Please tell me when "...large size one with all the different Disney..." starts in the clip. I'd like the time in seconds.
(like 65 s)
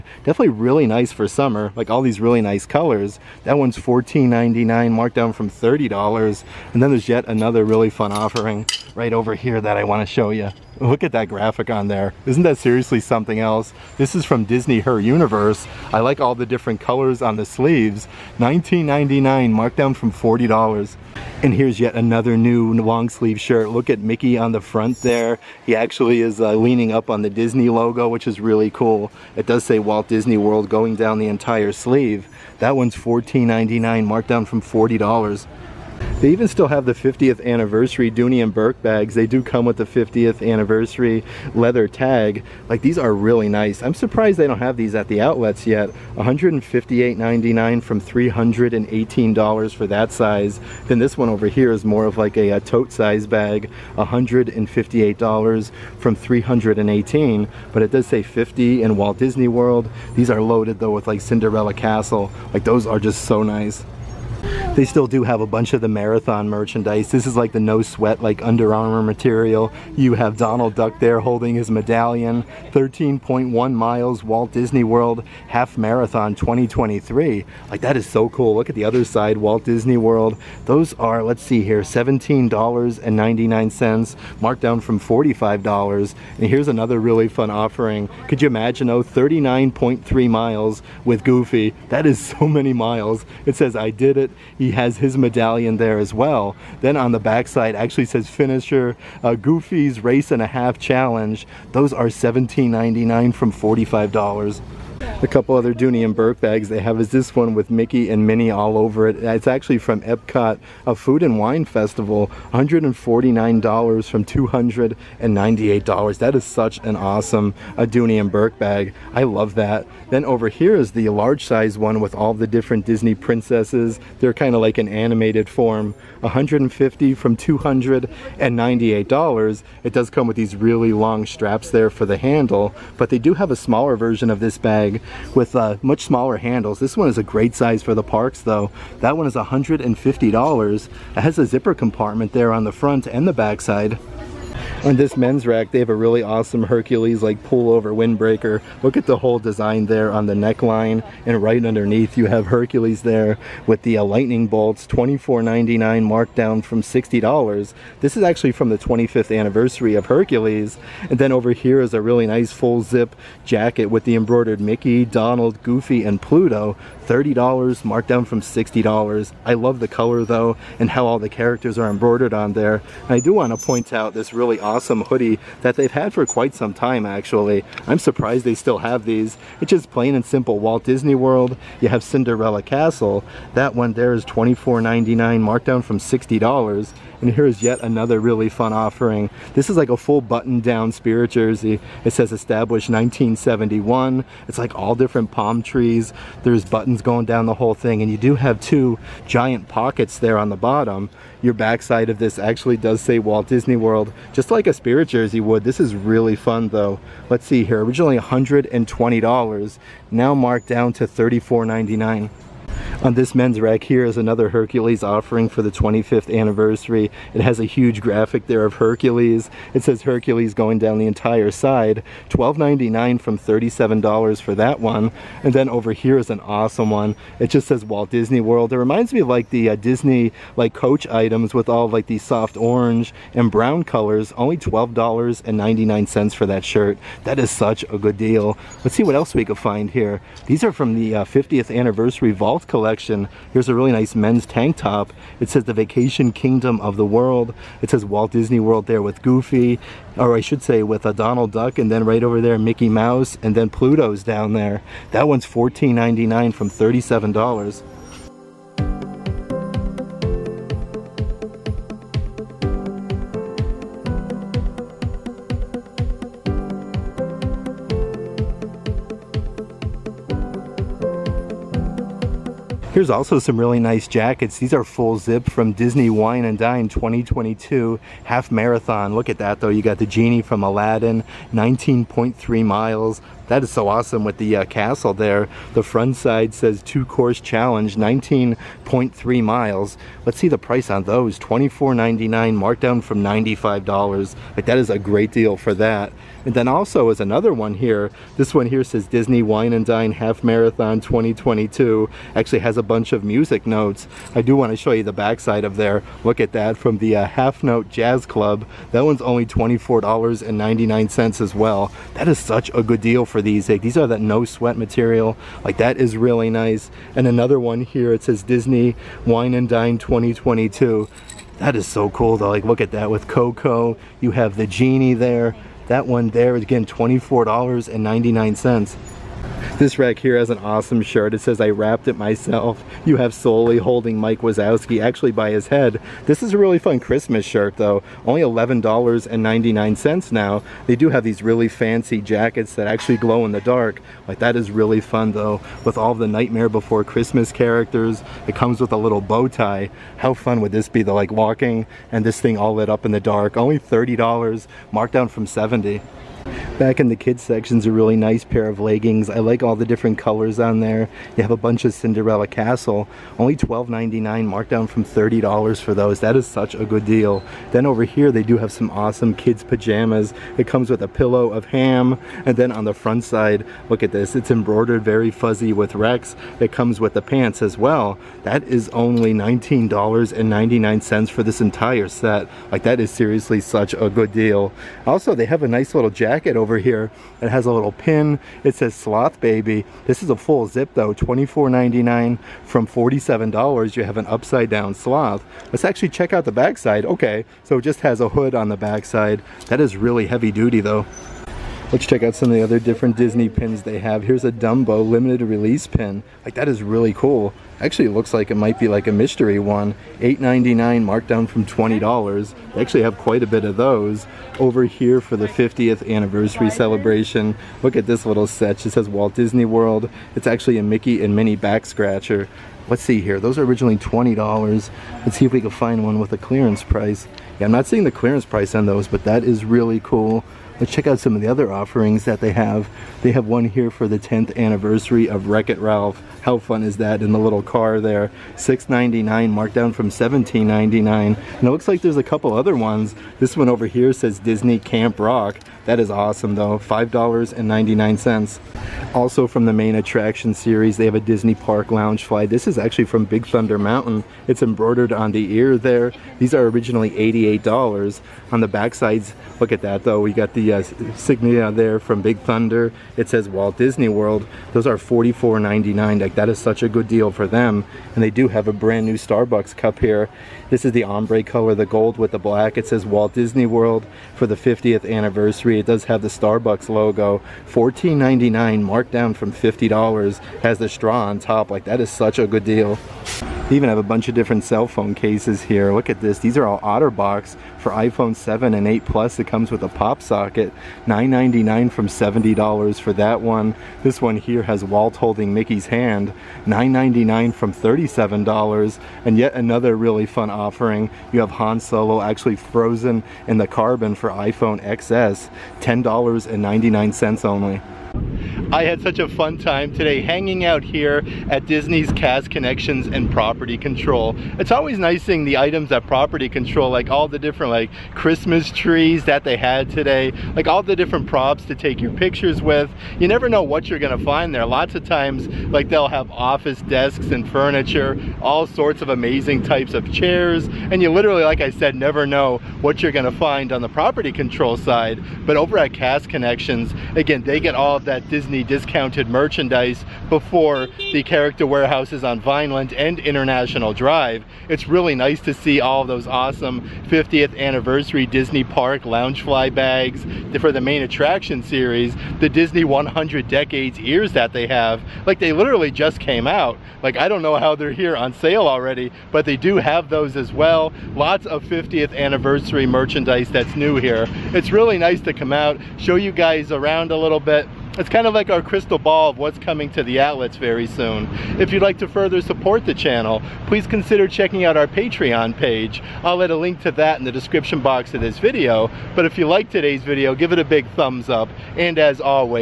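121 s.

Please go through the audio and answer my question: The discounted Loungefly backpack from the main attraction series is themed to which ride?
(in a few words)
Big Thunder Mountain.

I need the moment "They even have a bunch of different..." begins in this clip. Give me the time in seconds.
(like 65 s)
483 s.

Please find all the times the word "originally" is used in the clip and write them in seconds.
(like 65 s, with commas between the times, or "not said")
207 s, 423 s, 456 s.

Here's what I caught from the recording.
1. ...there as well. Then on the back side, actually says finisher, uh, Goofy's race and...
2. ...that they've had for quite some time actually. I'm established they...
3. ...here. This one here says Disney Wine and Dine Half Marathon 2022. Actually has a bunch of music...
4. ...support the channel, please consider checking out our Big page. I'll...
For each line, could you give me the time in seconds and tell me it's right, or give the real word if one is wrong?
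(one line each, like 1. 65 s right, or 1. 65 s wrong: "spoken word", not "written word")
1. 95 s right
2. 175 s wrong: "surprised", not "established"
3. 297 s right
4. 572 s wrong: "Patreon", not "Big".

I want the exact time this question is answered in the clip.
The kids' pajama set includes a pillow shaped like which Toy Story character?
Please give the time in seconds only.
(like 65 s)
371 s.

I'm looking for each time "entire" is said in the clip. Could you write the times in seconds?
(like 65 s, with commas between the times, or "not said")
31 s, 221 s, 381 s.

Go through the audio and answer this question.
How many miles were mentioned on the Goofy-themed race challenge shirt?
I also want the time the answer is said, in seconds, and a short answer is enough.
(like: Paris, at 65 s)
39.3, at 89 s.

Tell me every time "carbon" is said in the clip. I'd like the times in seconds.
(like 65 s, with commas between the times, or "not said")
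503 s.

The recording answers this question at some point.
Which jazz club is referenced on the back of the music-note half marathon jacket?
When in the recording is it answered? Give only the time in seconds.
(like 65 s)
307 s.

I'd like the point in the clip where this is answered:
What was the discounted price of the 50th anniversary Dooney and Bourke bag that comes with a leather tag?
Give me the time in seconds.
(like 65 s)
46 s.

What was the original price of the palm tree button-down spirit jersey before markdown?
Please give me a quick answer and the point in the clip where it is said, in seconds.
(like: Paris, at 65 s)
$120, at 208 s.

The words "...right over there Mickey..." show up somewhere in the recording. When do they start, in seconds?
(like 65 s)
252 s.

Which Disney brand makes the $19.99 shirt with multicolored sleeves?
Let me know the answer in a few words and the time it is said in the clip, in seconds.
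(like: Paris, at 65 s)
Her Universe, at 14 s.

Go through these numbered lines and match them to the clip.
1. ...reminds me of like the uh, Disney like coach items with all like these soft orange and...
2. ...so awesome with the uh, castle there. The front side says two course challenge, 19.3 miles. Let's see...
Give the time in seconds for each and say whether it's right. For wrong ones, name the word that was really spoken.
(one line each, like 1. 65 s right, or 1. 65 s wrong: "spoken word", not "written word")
1. 228 s right
2. 283 s right.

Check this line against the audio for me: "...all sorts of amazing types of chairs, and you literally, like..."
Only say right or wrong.
right.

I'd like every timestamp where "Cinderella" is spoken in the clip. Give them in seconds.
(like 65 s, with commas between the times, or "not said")
61 s, 182 s, 361 s.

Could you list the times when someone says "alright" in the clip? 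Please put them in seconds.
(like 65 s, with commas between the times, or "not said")
not said.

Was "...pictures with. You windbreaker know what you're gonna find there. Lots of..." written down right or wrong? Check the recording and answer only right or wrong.
wrong.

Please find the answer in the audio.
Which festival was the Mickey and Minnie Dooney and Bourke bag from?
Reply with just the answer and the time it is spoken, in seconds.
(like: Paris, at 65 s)
Food and Wine Festival, at 110 s.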